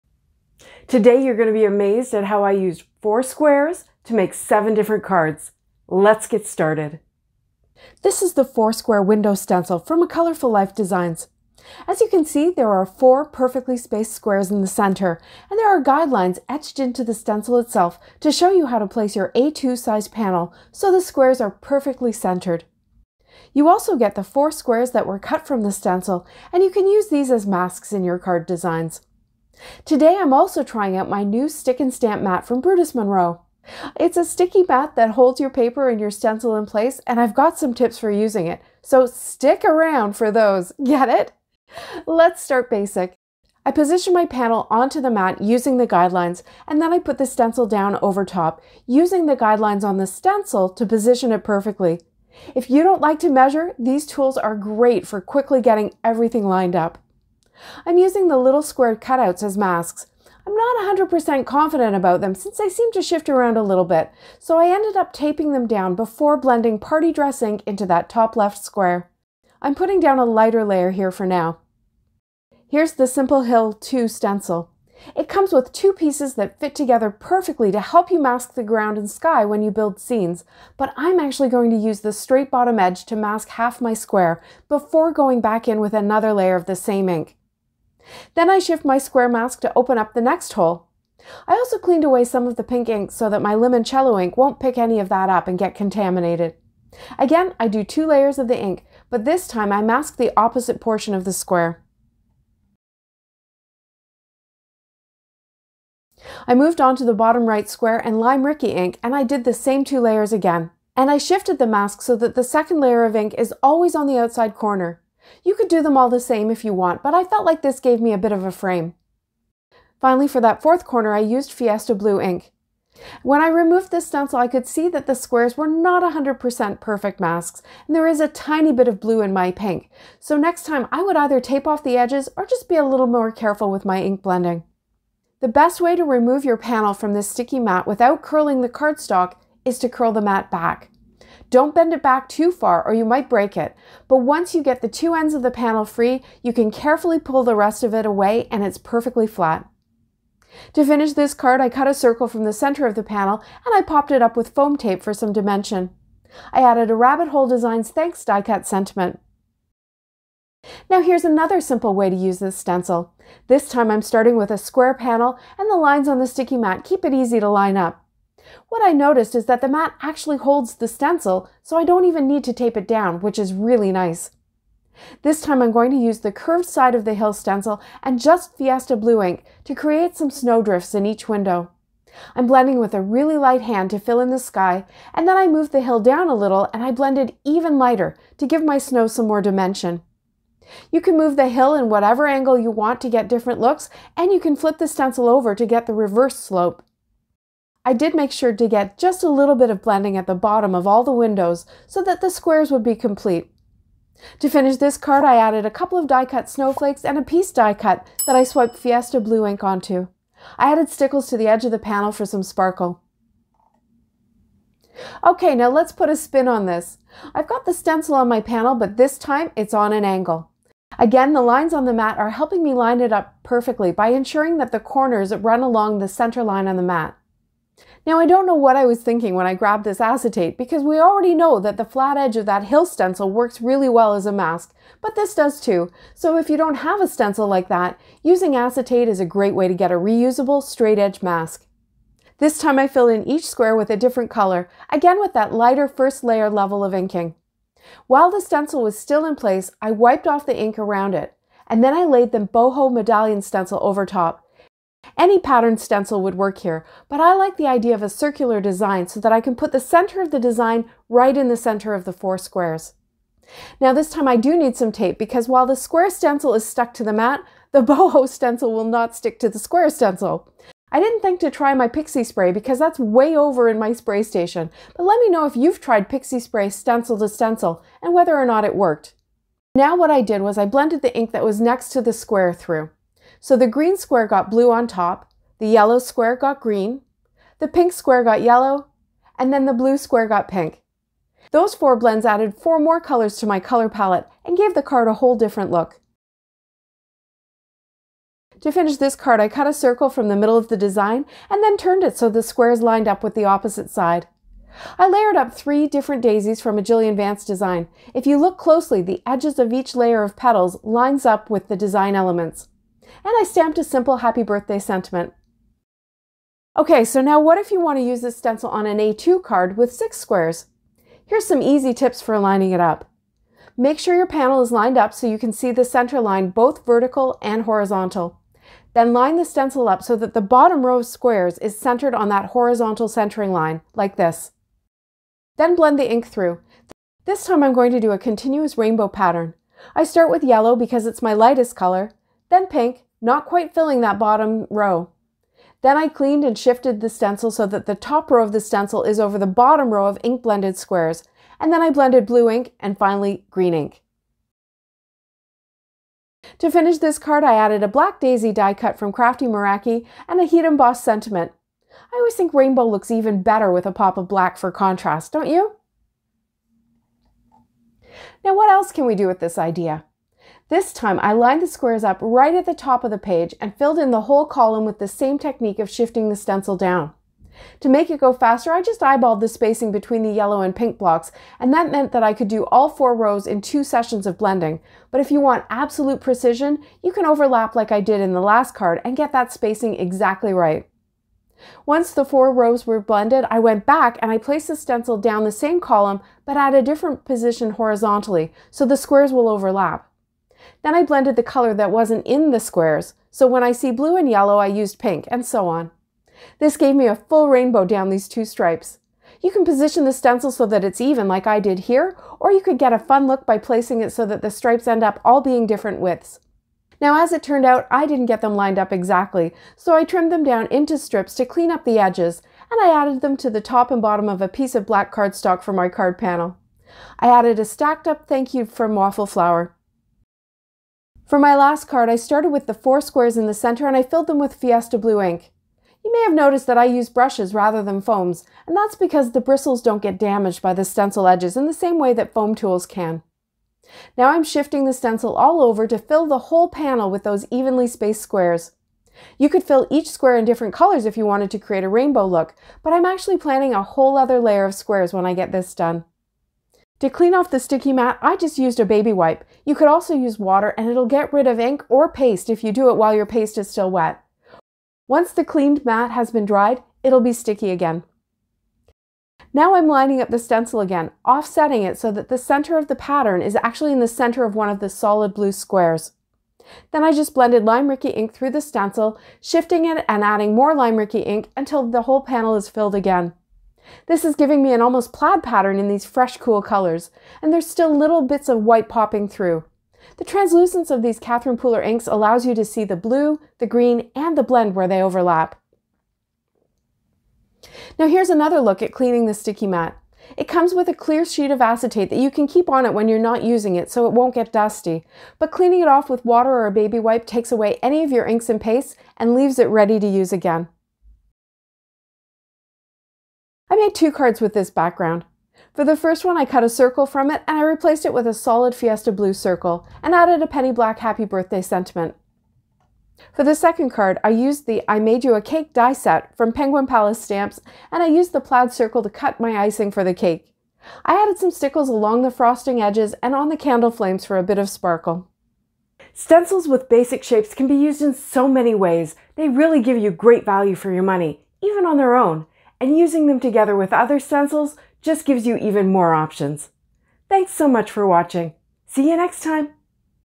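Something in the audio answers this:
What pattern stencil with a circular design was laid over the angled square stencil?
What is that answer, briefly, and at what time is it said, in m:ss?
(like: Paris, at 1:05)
Boho Medallion, at 4:12.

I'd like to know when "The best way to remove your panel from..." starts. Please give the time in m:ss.
2:15.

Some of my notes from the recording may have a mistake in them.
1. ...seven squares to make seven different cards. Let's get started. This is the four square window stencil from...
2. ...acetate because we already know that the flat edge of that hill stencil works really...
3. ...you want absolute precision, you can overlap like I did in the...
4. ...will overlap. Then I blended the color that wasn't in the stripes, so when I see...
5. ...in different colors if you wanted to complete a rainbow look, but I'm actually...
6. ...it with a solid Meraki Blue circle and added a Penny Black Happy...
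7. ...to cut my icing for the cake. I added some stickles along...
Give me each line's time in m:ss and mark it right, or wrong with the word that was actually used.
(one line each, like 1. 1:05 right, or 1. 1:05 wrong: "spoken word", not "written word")
1. 0:03 wrong: "four", not "seven"
2. 3:50 right
3. 6:25 right
4. 6:39 wrong: "squares", not "stripes"
5. 7:30 wrong: "create", not "complete"
6. 8:38 wrong: "Fiesta", not "Meraki"
7. 8:49 right.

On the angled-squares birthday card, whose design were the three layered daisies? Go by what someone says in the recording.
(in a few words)
Jillian Vance.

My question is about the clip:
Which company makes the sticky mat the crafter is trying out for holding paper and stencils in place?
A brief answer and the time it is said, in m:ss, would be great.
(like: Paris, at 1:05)
Brutus Monroe, at 0:32.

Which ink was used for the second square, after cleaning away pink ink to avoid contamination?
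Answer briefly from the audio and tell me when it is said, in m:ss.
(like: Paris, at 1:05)
Limoncello, at 1:33.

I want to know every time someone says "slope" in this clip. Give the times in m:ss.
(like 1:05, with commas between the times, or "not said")
3:16.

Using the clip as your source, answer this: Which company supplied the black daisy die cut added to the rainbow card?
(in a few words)
Crafty Meraki.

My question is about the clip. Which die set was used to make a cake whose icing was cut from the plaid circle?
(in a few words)
I Made You a Cake.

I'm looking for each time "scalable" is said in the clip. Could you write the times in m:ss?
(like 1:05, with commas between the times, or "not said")
not said.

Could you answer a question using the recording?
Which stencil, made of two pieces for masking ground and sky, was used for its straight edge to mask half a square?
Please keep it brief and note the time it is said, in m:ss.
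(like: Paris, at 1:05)
Simple Hill 2, at 1:13.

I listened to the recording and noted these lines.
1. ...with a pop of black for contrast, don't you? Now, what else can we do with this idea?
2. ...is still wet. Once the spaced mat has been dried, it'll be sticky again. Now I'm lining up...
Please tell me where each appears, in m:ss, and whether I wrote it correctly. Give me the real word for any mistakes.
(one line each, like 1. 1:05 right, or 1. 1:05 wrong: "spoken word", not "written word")
1. 6:03 right
2. 7:43 wrong: "cleaned", not "spaced".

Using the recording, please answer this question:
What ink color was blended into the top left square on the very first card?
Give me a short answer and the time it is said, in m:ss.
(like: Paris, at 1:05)
Party Dress, at 1:06.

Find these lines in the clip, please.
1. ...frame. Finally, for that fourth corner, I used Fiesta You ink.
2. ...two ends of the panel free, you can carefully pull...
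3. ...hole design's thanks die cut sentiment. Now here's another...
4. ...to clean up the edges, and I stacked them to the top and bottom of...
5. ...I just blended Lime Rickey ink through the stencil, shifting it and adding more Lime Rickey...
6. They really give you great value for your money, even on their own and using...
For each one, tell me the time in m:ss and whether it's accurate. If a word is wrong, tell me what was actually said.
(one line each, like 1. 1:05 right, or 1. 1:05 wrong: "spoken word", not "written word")
1. 1:58 wrong: "Blue", not "You"
2. 2:24 right
3. 2:37 right
4. 7:01 wrong: "added", not "stacked"
5. 7:57 right
6. 8:59 right.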